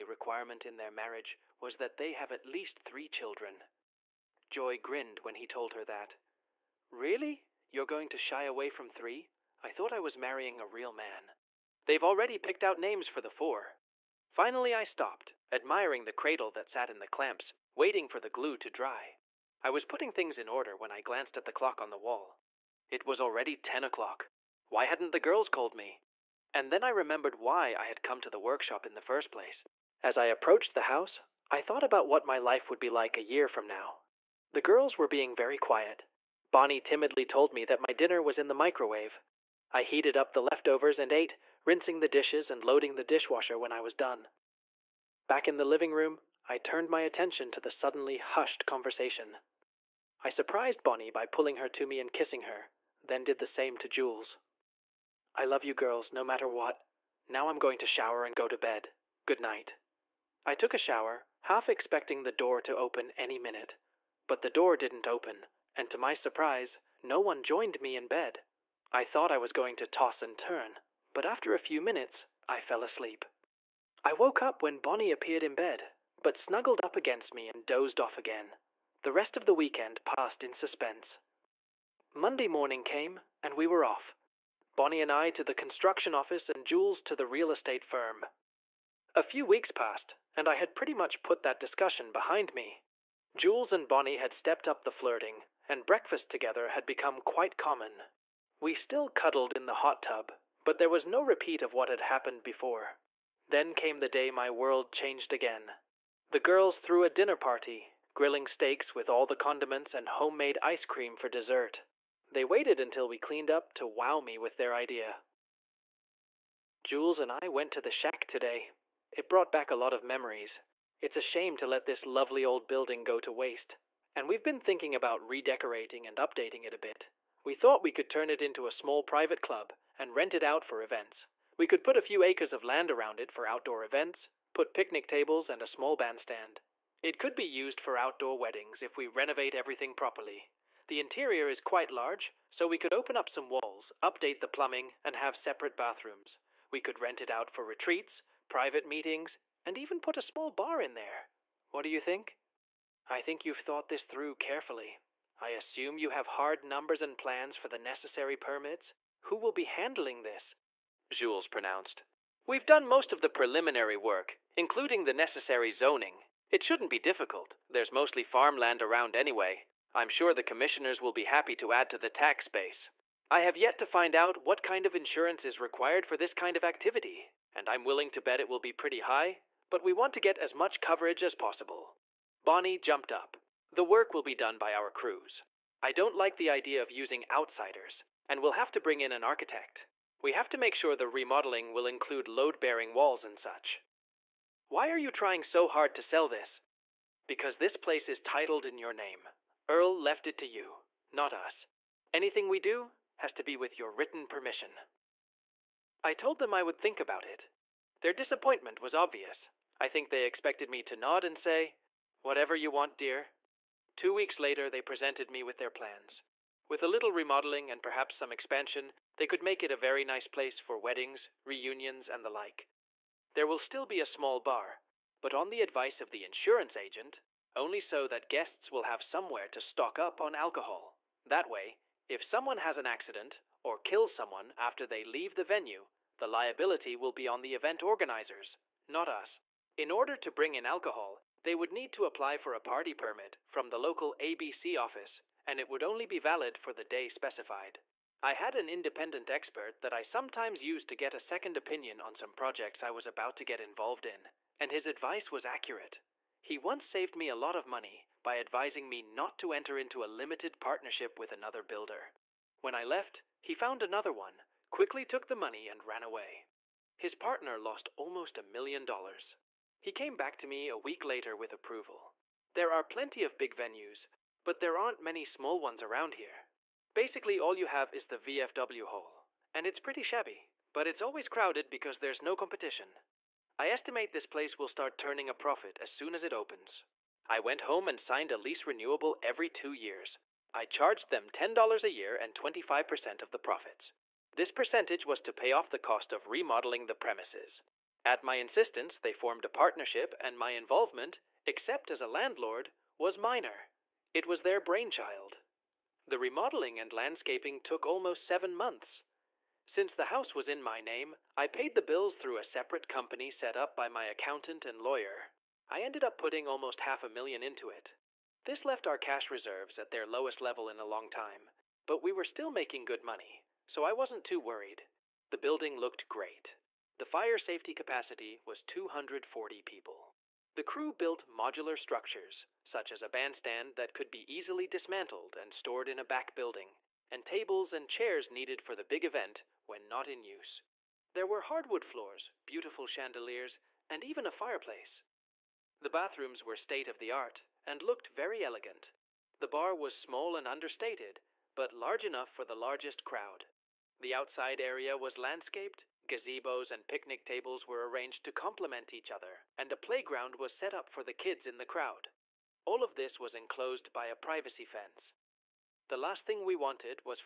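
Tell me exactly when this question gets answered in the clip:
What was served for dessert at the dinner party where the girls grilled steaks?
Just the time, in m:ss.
1:50.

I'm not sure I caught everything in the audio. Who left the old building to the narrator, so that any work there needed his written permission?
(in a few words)
Earl.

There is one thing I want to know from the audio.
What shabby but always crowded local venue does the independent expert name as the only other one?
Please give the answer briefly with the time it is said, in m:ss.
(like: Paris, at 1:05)
The VFW hall, at 4:38.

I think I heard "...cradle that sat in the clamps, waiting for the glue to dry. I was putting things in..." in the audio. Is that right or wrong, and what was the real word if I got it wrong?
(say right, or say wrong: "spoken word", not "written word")
right.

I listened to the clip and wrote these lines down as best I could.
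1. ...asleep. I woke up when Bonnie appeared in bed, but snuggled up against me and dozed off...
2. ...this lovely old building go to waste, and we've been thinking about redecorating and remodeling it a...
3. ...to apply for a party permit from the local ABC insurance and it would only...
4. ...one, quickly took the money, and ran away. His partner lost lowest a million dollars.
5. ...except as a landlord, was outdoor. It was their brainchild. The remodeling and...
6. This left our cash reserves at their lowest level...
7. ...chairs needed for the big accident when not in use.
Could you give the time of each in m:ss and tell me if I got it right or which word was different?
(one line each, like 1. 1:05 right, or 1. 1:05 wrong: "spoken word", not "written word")
1. 1:12 right
2. 2:01 wrong: "updating", not "remodeling"
3. 4:01 wrong: "office", not "insurance"
4. 4:24 wrong: "almost", not "lowest"
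5. 5:01 wrong: "minor", not "outdoor"
6. 5:18 right
7. 5:37 wrong: "event", not "accident".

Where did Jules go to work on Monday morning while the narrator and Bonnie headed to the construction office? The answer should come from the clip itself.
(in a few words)
The real estate firm.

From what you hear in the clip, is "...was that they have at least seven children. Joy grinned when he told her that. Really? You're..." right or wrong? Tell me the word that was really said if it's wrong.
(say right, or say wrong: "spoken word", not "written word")
wrong: "three", not "seven".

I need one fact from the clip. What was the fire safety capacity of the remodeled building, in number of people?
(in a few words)
240.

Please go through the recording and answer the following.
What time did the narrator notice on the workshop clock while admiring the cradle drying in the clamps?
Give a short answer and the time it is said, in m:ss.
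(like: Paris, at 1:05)
10 o'clock, at 0:23.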